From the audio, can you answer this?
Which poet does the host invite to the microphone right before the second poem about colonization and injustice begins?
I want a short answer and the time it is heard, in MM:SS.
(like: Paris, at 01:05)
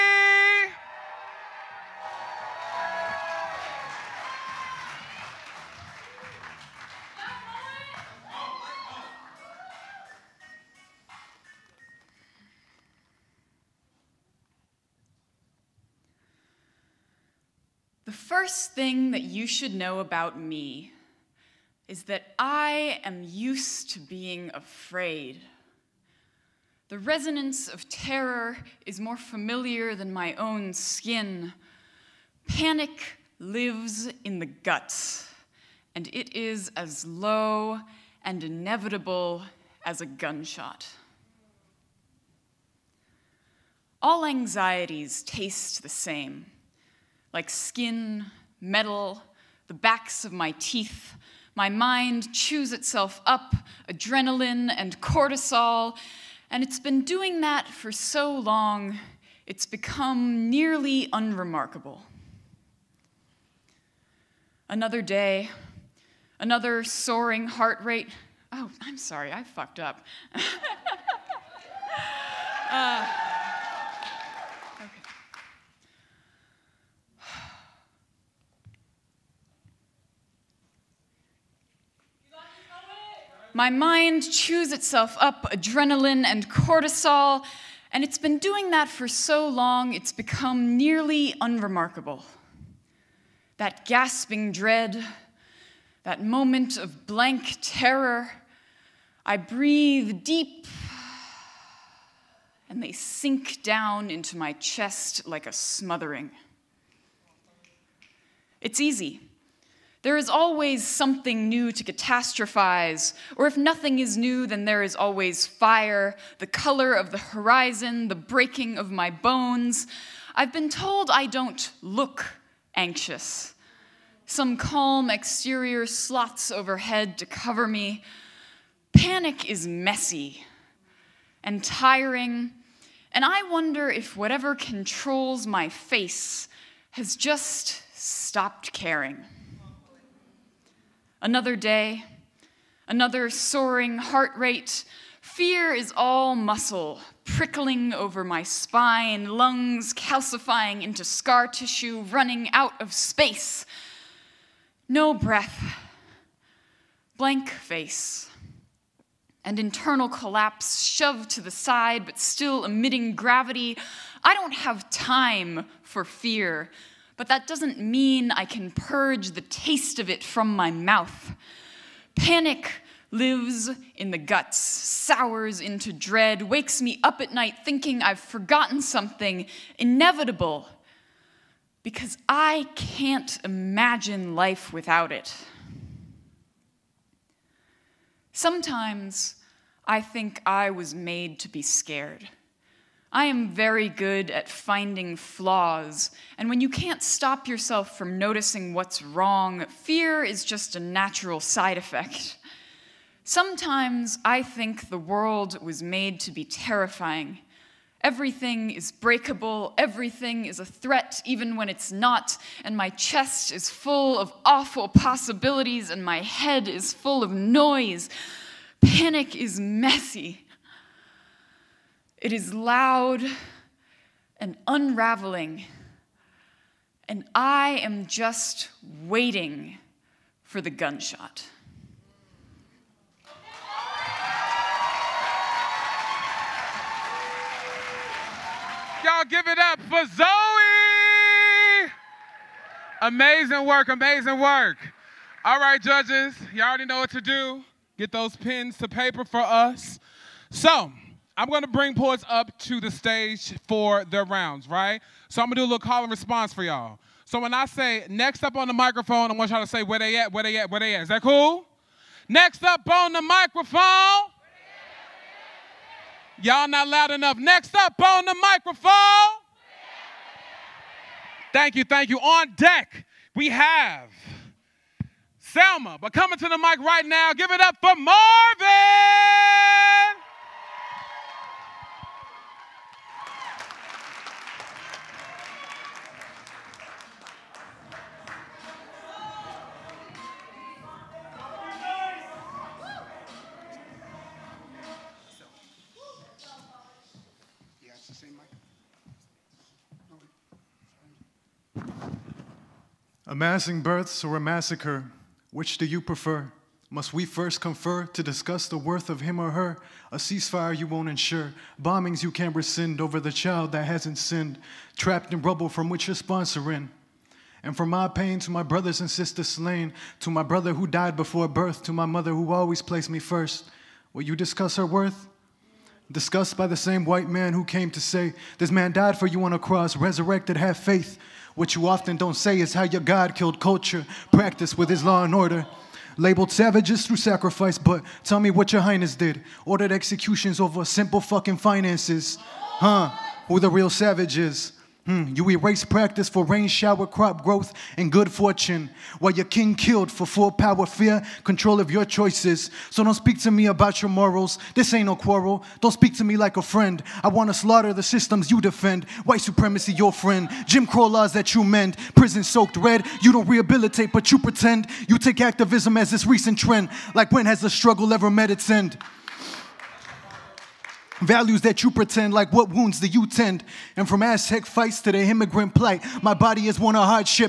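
Marvin, at 04:37.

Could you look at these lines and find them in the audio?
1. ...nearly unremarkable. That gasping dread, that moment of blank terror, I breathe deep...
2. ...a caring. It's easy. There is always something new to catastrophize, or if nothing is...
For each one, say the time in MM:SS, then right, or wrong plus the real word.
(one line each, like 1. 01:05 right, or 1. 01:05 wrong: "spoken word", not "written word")
1. 01:30 right
2. 01:45 wrong: "smothering", not "caring".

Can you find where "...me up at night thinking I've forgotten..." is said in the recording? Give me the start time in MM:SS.
02:56.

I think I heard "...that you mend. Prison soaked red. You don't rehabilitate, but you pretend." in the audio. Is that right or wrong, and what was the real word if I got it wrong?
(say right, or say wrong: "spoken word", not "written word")
right.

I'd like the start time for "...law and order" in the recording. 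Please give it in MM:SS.
05:35.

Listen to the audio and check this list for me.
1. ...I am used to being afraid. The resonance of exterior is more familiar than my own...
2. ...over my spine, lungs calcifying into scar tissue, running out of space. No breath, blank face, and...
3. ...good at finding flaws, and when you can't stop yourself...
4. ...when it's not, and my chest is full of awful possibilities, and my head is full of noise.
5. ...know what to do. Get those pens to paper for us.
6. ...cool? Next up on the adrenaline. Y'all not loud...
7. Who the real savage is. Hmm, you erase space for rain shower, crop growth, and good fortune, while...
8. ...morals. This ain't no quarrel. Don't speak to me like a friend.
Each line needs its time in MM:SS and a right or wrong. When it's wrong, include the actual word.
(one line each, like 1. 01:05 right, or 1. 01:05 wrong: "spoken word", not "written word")
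1. 00:22 wrong: "terror", not "exterior"
2. 02:27 right
3. 03:13 right
4. 03:31 right
5. 04:06 right
6. 04:21 wrong: "microphone", not "adrenaline"
7. 05:43 wrong: "practice", not "space"
8. 05:54 right.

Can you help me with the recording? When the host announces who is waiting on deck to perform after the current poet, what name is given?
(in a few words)
Selma.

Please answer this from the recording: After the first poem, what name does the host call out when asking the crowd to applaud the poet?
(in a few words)
Zoe.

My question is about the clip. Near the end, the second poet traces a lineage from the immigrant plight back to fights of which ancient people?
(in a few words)
Aztec.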